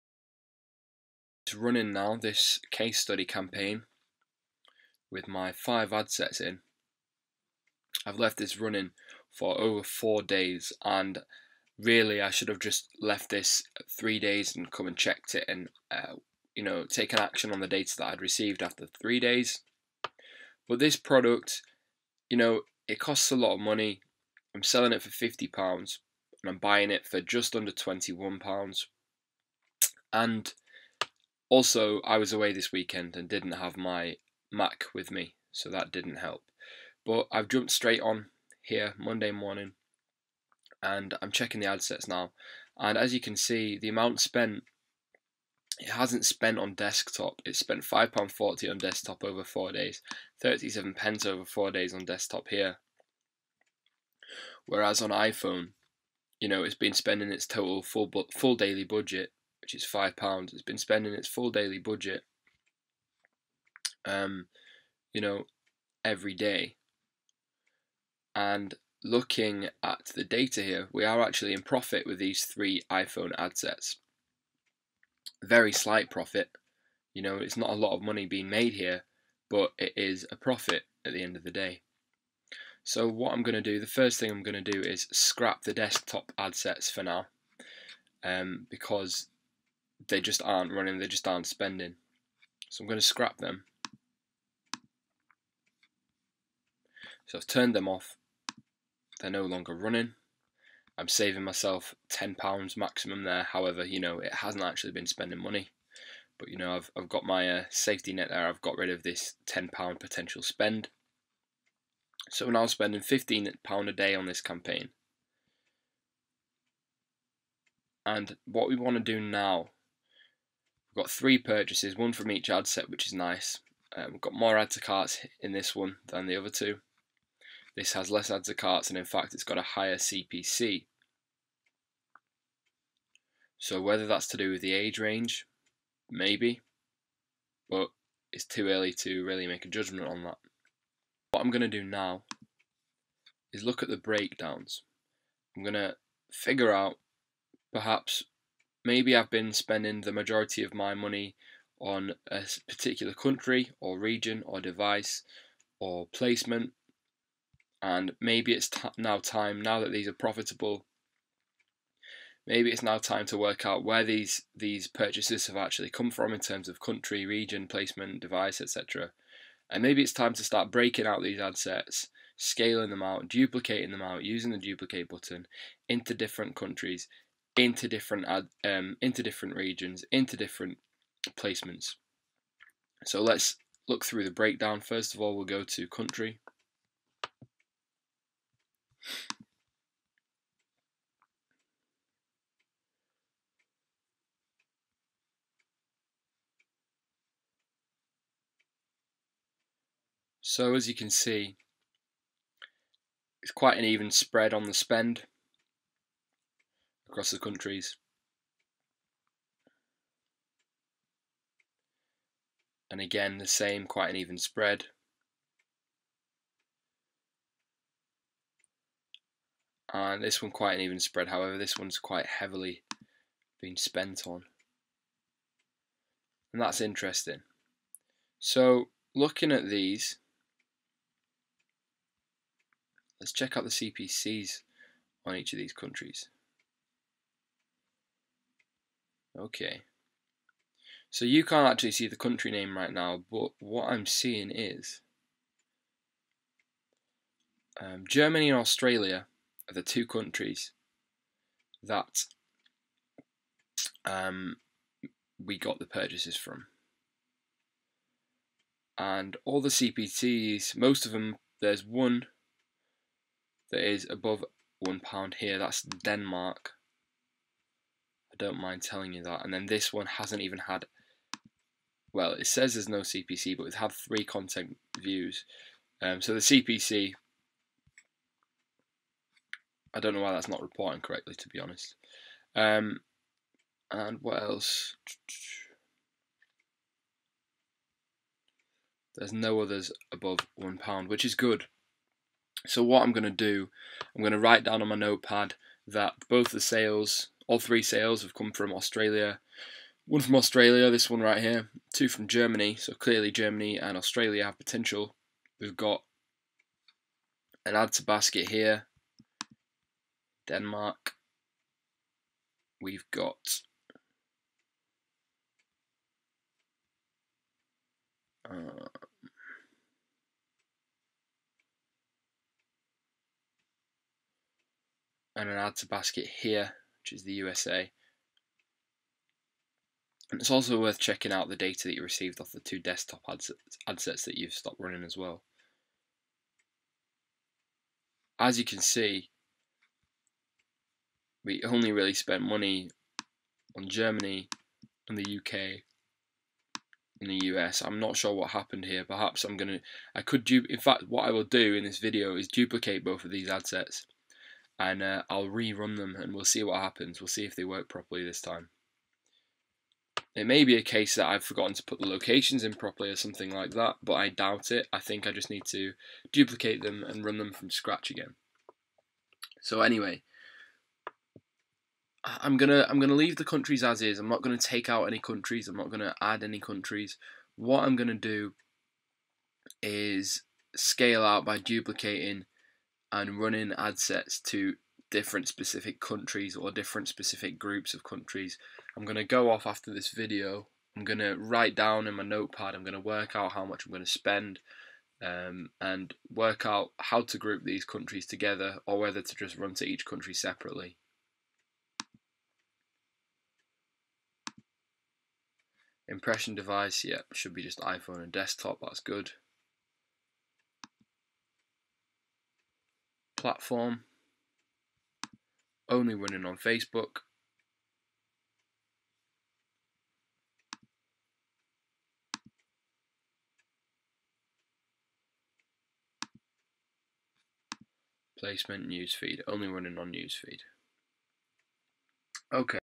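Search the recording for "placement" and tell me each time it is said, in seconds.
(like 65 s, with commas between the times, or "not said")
156 s, 167 s, 181 s, 428 s.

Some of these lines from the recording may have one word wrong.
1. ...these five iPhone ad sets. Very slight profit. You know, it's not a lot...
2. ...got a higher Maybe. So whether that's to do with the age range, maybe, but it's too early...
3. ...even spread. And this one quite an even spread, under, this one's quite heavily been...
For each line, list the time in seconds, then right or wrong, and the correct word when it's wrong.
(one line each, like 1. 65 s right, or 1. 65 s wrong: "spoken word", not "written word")
1. 72 s wrong: "three", not "five"
2. 129 s wrong: "CPC", not "Maybe"
3. 214 s wrong: "however", not "under".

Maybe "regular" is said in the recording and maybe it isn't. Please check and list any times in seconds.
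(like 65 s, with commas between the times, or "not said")
not said.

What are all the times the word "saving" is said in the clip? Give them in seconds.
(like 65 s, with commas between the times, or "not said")
101 s.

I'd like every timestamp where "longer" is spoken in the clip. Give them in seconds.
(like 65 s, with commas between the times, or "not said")
99 s.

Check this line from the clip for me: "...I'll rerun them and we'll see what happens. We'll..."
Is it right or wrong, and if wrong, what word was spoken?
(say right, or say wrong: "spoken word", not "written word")
right.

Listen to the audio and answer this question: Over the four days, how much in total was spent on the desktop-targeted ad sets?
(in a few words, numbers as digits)
£5.40.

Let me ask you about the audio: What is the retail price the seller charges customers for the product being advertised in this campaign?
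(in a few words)
£50.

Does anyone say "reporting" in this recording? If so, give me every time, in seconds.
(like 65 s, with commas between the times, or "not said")
280 s.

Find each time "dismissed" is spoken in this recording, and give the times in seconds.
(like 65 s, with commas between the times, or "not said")
not said.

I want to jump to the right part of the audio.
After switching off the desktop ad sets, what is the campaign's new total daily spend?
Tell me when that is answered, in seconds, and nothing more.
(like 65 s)
113 s.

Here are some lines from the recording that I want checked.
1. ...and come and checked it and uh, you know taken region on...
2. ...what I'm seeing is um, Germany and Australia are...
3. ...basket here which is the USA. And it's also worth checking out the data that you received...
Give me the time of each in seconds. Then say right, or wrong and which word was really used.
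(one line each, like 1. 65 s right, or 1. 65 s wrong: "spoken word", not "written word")
1. 14 s wrong: "action", not "region"
2. 243 s right
3. 325 s right.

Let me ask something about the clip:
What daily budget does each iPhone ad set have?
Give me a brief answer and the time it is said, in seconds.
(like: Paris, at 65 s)
£5, at 59 s.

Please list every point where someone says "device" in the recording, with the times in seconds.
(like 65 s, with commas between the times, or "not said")
154 s, 168 s, 406 s.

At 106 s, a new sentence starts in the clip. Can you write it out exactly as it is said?
But, you know, I've, I've got my uh, safety net there.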